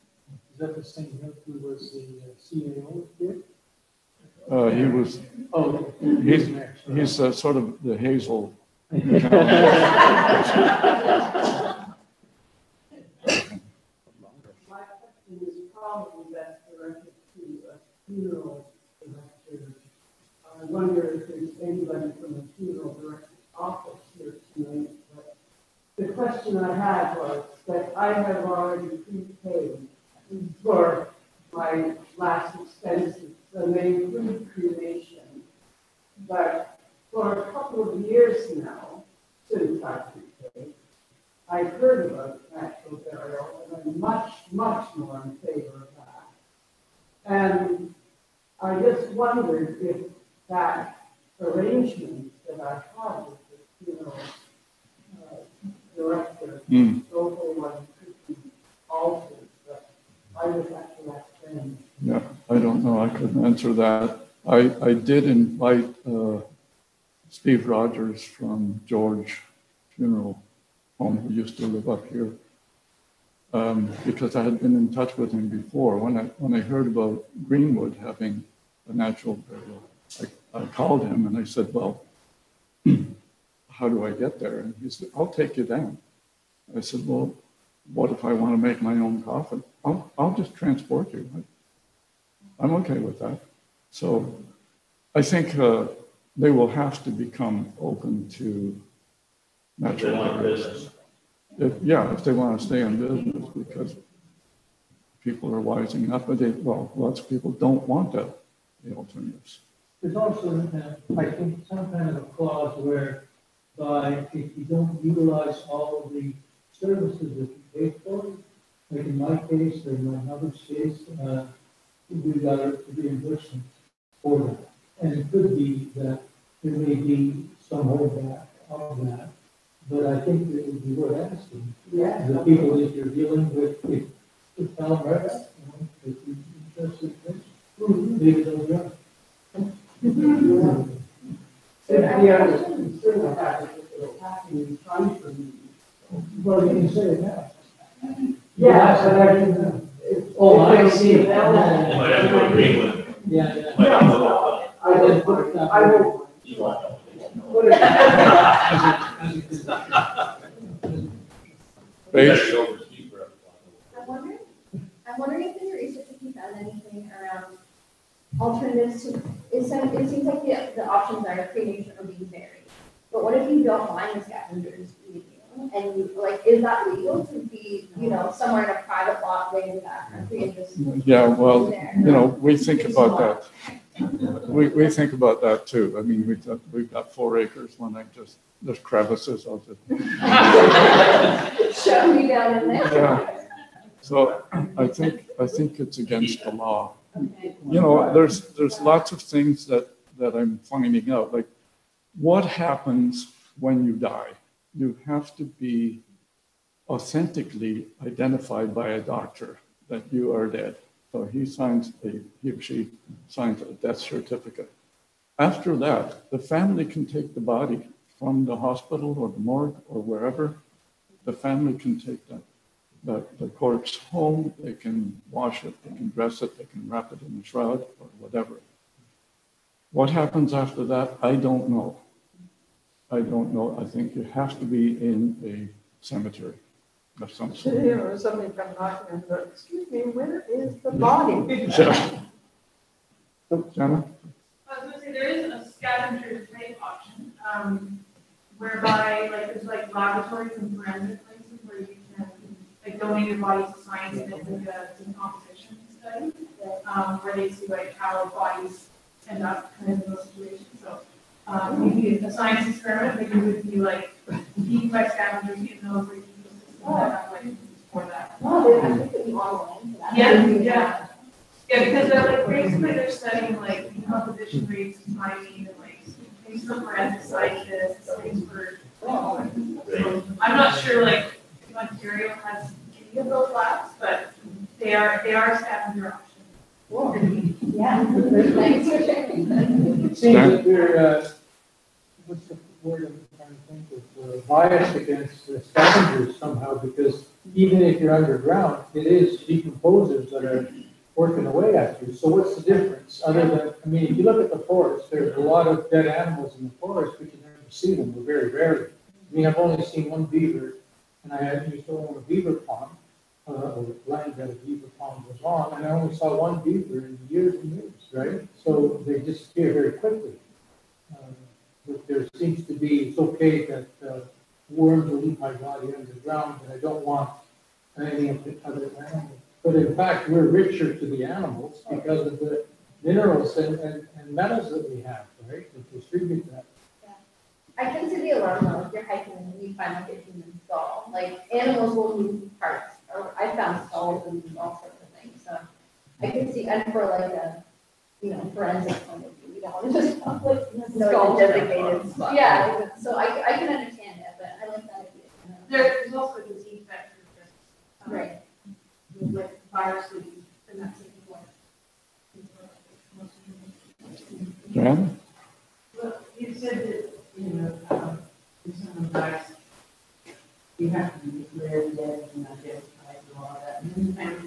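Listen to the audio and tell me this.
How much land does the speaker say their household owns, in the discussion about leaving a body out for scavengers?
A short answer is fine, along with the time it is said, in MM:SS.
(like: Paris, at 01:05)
4 acres, at 03:07.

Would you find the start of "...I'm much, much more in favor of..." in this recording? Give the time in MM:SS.
00:43.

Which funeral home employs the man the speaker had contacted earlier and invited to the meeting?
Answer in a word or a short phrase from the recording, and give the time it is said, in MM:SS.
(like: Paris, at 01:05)
George Funeral Home, at 01:08.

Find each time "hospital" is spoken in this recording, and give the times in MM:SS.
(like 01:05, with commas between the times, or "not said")
03:38.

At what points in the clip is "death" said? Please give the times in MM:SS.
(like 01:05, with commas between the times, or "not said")
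03:33, 06:11.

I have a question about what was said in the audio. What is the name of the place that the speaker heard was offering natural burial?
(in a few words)
Greenwood.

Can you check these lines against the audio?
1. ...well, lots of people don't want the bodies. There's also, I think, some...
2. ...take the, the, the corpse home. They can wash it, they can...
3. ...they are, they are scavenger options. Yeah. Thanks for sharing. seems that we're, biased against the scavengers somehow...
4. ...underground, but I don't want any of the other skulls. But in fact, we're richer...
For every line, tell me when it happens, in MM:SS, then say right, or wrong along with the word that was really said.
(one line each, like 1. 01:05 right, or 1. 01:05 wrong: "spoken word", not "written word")
1. 01:46 wrong: "alternatives", not "bodies"
2. 03:41 right
3. 04:44 right
4. 05:25 wrong: "animals", not "skulls".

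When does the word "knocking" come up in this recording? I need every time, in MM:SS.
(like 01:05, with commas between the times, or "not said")
03:58.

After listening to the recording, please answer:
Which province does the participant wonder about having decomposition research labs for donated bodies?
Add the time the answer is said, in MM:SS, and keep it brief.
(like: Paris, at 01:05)
Ontario, at 04:41.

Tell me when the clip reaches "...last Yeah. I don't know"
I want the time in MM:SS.
01:01.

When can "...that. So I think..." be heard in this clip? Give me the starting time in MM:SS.
01:33.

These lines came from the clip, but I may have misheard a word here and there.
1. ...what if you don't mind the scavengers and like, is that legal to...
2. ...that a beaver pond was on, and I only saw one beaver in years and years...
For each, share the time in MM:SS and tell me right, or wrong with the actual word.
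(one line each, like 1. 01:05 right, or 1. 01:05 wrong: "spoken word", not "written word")
1. 02:53 right
2. 05:14 right.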